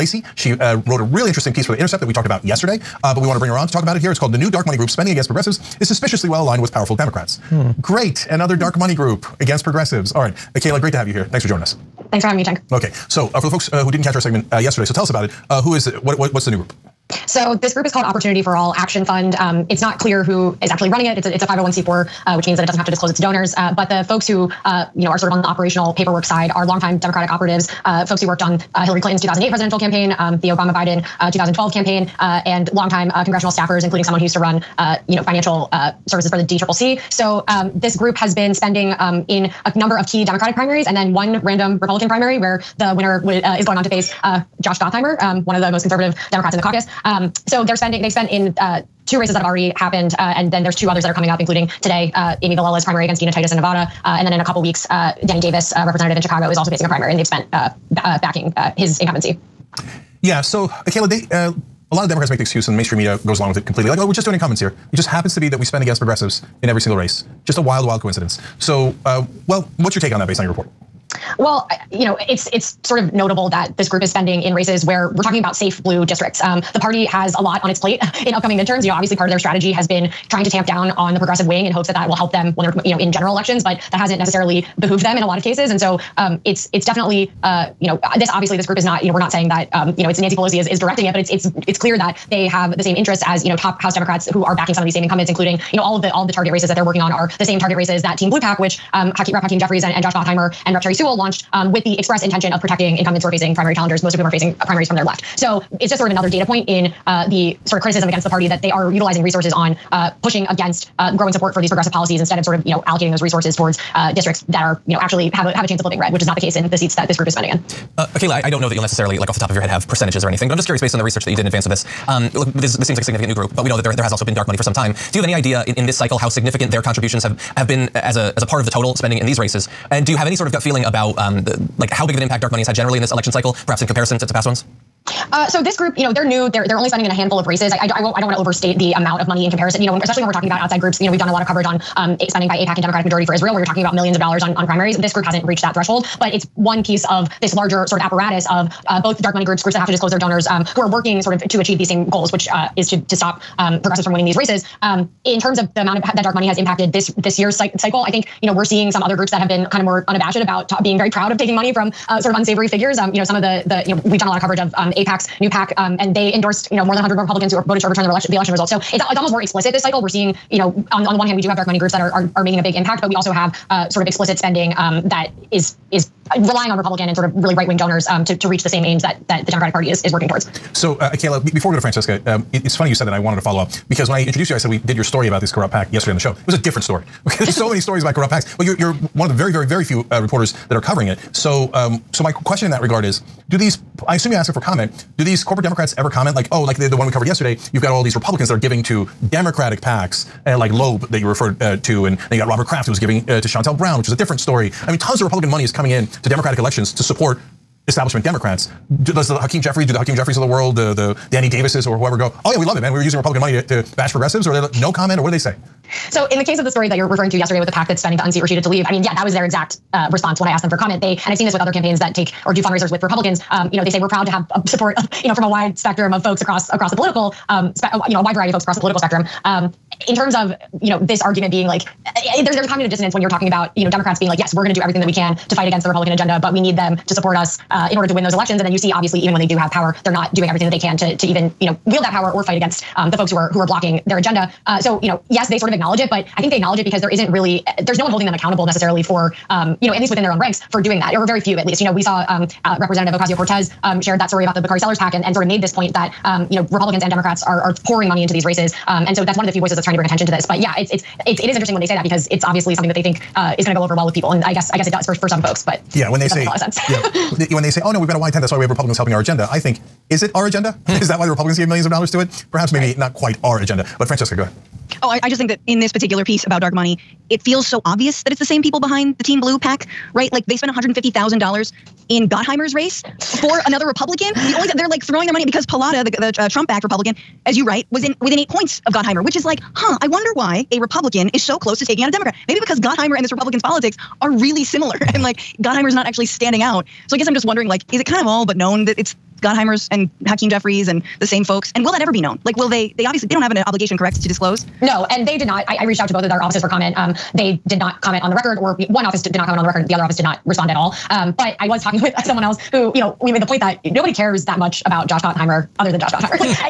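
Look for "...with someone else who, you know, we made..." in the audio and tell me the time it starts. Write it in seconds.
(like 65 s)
312 s.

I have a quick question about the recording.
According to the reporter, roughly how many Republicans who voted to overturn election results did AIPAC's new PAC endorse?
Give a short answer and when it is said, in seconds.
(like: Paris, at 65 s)
more than 100, at 166 s.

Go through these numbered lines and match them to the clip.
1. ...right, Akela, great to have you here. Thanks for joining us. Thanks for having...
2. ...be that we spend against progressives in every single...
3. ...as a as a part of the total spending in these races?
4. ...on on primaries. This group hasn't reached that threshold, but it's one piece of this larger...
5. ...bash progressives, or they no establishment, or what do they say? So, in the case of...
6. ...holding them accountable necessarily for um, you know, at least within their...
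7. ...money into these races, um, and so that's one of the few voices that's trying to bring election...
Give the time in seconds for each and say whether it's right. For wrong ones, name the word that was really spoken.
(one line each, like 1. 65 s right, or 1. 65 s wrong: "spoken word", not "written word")
1. 10 s right
2. 65 s right
3. 127 s right
4. 144 s right
5. 213 s wrong: "comment", not "establishment"
6. 248 s right
7. 258 s wrong: "attention", not "election".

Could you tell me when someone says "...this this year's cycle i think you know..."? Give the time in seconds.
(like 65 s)
156 s.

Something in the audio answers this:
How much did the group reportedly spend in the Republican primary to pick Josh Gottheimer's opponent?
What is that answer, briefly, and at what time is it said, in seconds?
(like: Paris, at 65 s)
$150,000, at 280 s.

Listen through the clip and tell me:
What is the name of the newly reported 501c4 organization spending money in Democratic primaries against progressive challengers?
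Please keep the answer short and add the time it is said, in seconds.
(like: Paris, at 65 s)
Opportunity for All Action Fund, at 18 s.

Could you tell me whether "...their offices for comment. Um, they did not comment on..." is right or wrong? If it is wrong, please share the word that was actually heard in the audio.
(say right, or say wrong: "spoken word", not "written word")
right.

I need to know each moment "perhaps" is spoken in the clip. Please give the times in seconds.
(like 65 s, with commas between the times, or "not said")
133 s, 272 s.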